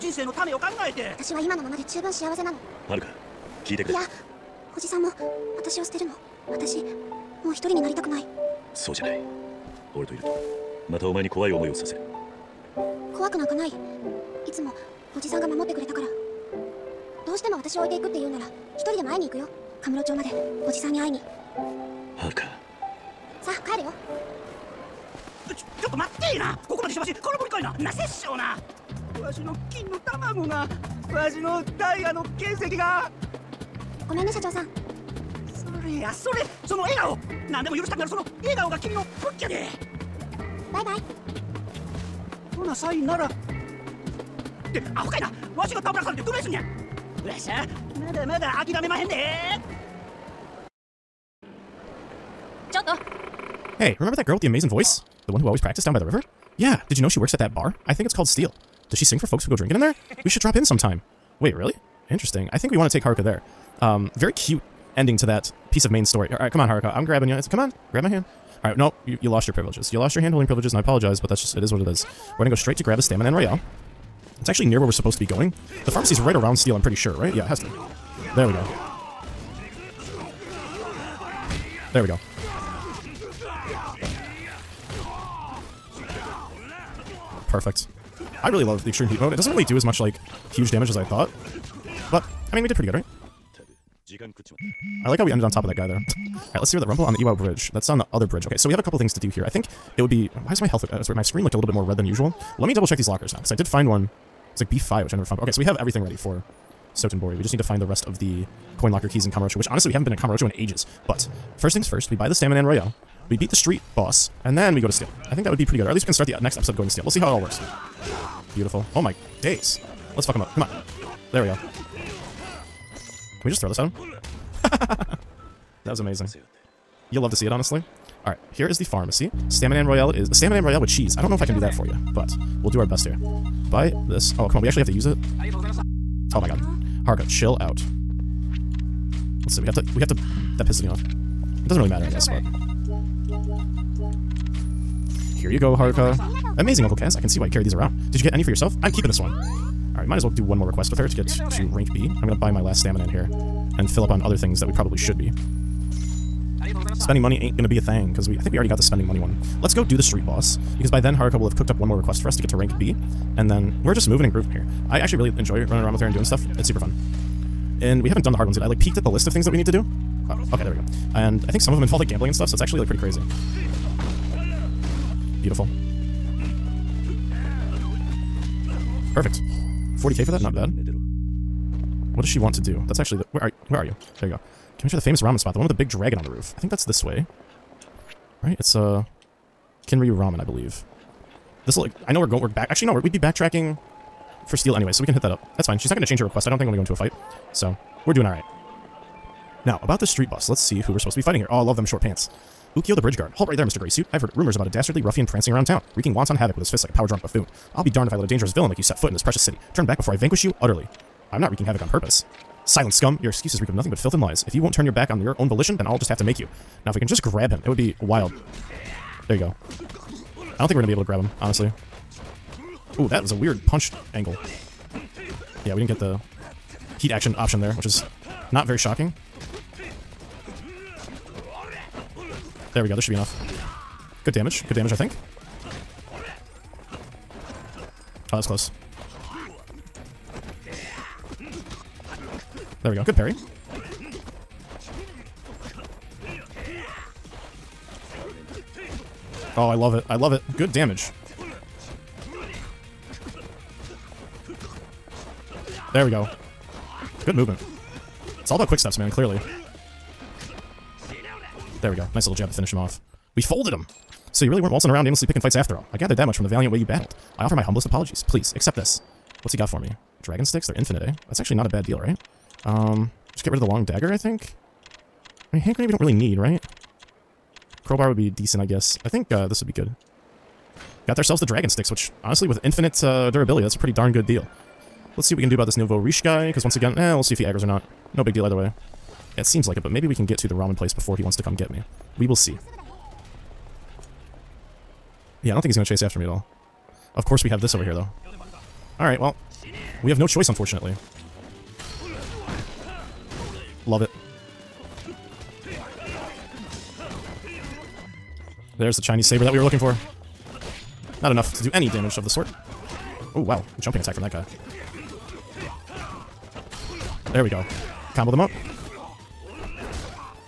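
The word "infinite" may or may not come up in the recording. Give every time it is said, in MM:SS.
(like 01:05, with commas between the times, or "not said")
04:30, 04:42.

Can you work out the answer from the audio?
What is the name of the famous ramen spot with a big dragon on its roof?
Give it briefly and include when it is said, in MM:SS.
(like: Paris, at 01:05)
Kinryu Ramen, at 03:09.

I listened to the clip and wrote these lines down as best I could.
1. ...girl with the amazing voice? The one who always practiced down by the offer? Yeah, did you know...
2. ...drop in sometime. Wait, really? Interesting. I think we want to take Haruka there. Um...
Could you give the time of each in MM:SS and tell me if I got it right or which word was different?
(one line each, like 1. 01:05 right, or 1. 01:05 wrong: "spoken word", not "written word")
1. 00:54 wrong: "river", not "offer"
2. 01:00 right.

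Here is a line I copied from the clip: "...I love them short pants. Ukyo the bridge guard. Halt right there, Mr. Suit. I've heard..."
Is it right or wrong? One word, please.
right.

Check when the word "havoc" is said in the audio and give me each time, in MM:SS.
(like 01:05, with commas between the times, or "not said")
03:26, 03:31.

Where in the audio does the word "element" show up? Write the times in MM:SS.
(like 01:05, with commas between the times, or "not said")
not said.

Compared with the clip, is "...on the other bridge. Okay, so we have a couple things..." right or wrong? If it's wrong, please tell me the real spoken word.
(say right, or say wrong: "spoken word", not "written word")
right.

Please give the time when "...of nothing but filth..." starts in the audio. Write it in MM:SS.
03:33.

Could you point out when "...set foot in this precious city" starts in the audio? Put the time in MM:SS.
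03:28.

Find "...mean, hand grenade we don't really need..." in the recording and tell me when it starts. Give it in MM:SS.
04:35.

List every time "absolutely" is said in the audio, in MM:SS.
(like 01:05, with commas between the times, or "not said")
not said.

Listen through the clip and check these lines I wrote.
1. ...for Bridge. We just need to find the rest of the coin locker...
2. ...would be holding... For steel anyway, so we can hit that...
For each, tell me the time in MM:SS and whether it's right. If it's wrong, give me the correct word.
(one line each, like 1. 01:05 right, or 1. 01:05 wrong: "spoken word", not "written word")
1. 01:46 wrong: "Sotenbori", not "Bridge"
2. 03:12 wrong: "backtracking", not "holding".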